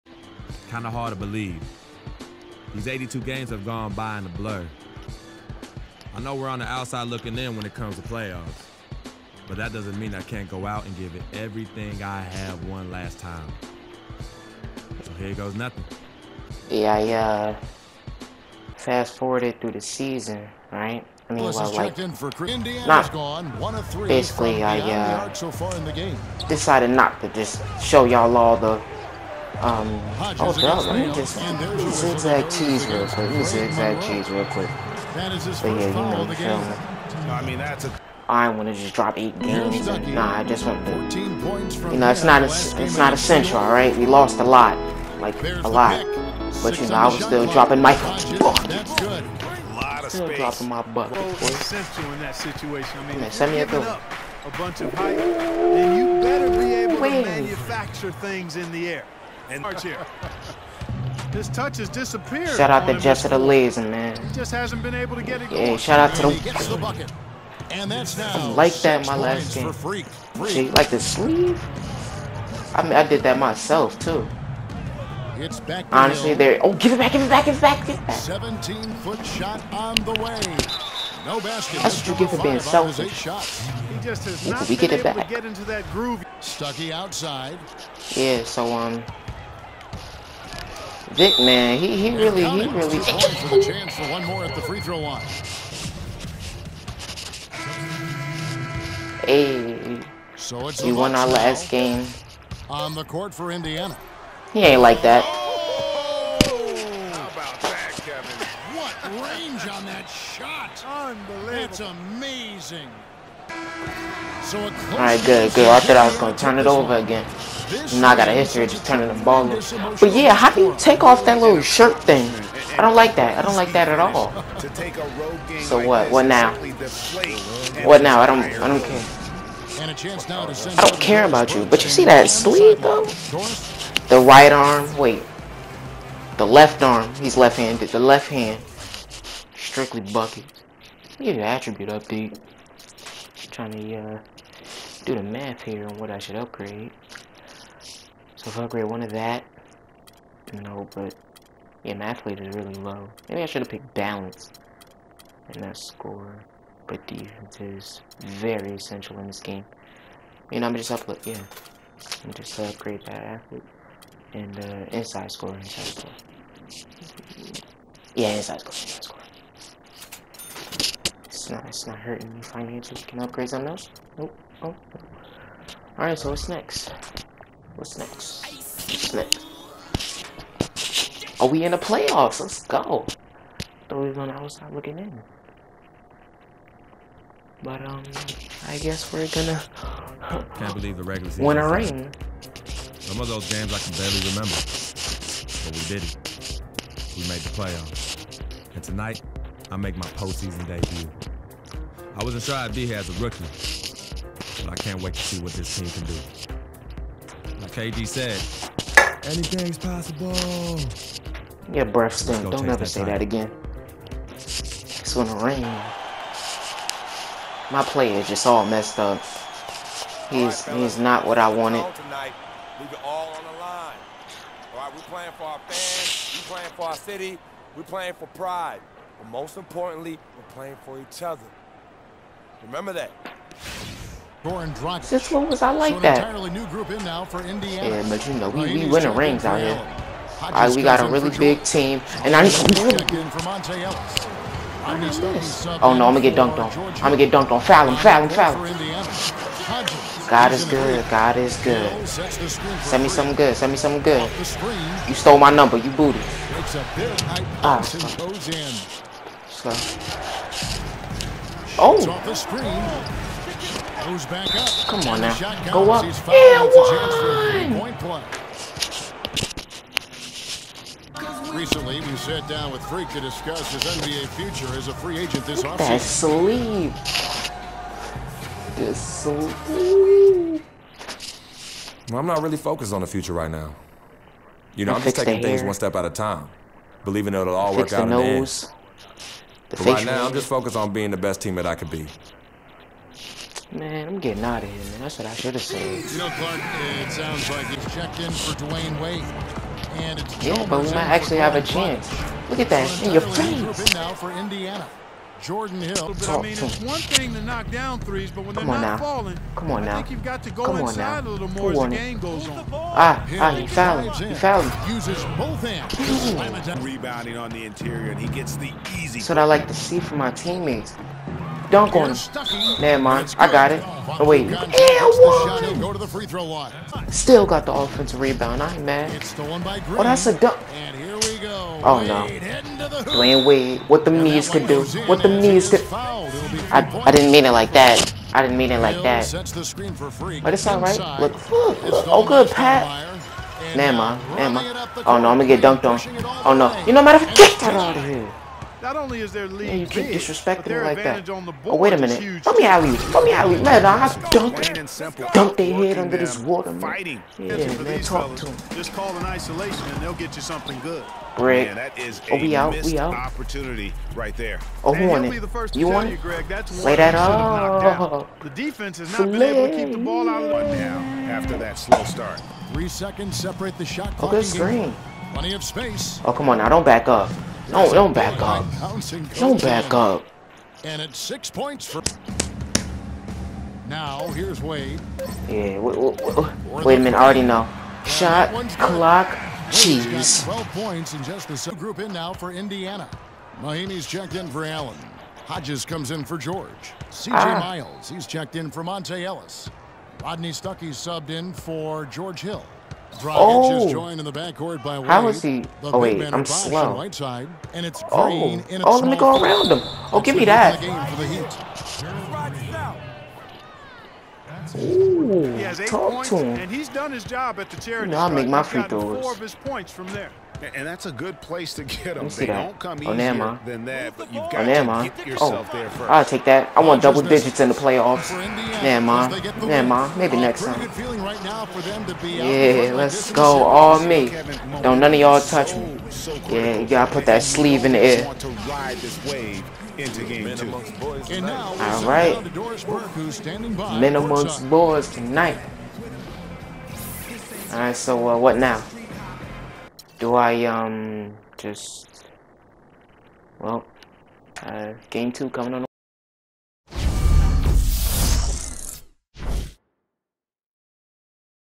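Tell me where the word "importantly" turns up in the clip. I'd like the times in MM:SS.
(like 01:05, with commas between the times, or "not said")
03:49.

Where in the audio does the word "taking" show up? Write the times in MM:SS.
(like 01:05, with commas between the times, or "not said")
04:45.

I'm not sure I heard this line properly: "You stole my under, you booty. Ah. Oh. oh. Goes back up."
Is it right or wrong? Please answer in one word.
wrong.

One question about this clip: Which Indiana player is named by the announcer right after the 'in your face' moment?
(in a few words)
Jordan Hill.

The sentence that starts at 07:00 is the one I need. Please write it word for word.
And that's a good place to get them.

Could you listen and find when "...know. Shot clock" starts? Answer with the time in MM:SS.
06:27.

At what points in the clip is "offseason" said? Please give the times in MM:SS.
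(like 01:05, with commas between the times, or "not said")
04:35.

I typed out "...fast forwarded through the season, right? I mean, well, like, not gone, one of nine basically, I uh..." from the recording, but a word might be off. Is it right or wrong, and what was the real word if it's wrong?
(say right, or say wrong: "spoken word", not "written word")
wrong: "three", not "nine".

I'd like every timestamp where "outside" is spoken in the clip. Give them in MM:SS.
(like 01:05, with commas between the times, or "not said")
00:06, 01:26, 03:04.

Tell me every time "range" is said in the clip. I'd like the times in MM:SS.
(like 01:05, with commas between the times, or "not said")
01:49.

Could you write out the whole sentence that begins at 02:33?
Maybe I should have picked balance and that score.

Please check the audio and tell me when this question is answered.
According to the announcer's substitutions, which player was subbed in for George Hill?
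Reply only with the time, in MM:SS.
06:40.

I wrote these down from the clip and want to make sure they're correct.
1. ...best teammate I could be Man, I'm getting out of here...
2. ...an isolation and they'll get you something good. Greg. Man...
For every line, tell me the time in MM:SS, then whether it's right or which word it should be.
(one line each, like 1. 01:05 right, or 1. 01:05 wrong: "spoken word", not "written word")
1. 04:51 right
2. 05:59 right.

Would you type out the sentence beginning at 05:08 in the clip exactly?
falling, Come on I think you've got to go Come inside a little more Come as the game goes on.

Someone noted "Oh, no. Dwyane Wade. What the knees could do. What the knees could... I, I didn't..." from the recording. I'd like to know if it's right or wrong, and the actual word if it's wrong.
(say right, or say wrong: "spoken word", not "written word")
right.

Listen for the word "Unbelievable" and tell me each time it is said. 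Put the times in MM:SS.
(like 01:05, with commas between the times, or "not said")
01:50.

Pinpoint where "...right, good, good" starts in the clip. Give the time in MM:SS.
01:54.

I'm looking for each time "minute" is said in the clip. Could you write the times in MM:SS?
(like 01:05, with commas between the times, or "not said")
05:51, 06:27.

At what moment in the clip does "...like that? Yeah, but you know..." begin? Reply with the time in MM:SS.
03:55.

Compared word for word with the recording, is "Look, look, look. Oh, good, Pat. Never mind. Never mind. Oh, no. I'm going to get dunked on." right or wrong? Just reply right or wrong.
right.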